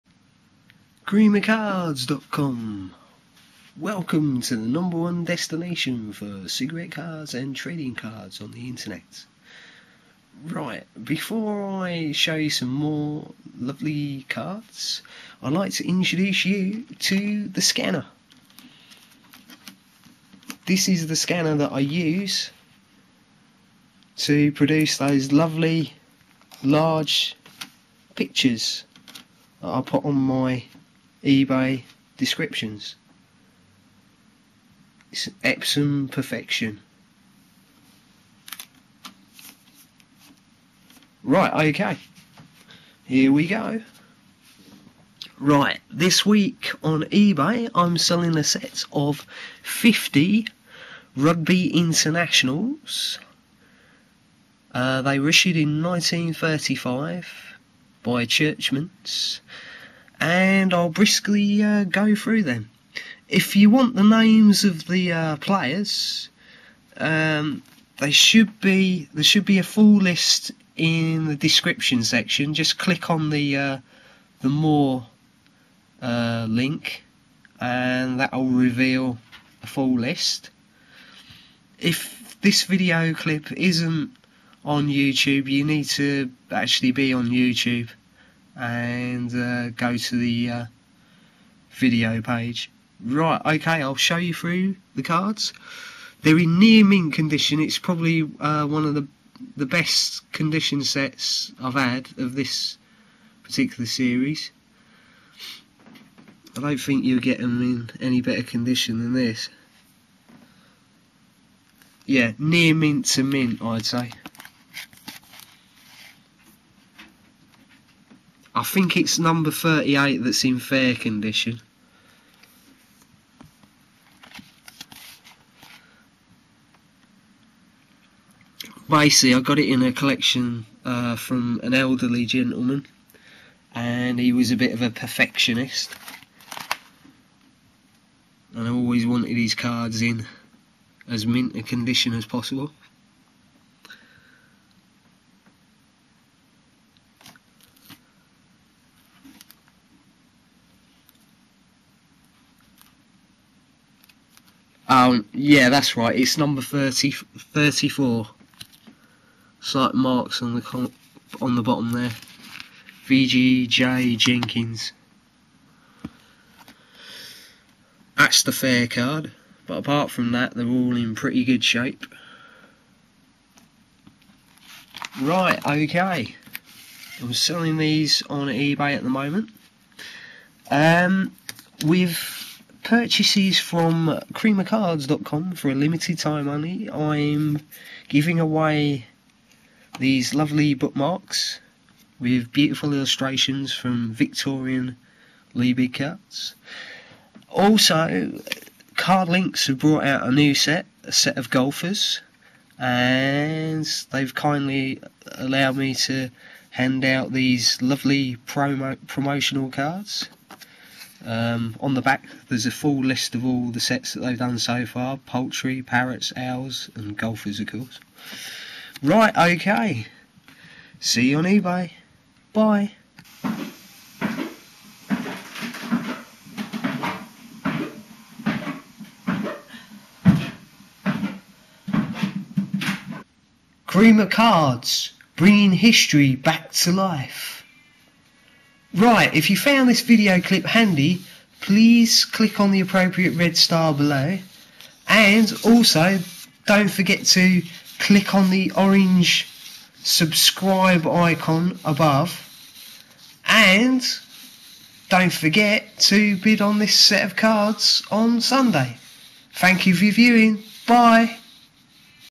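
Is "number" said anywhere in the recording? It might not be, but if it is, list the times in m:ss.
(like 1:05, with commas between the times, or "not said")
0:04, 1:59, 2:36.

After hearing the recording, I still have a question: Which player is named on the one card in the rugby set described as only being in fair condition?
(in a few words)
VGJ Jenkins.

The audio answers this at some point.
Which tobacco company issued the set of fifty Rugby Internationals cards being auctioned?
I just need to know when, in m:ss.
0:58.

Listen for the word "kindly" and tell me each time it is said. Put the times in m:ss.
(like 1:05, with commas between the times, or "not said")
3:24.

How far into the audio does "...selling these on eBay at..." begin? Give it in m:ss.
2:57.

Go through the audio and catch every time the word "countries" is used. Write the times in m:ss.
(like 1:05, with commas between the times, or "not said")
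not said.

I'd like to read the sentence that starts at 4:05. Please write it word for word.
And also, don't forget to click on the orange subscribe icon above.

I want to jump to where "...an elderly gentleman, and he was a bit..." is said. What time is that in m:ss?
2:11.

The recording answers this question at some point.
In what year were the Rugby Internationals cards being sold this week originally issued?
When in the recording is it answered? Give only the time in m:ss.
0:55.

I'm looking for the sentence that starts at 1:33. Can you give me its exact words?
Right, okay, I'll show you through the cards.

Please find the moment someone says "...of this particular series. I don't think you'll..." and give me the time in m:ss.
1:42.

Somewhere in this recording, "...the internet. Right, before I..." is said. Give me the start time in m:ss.
0:08.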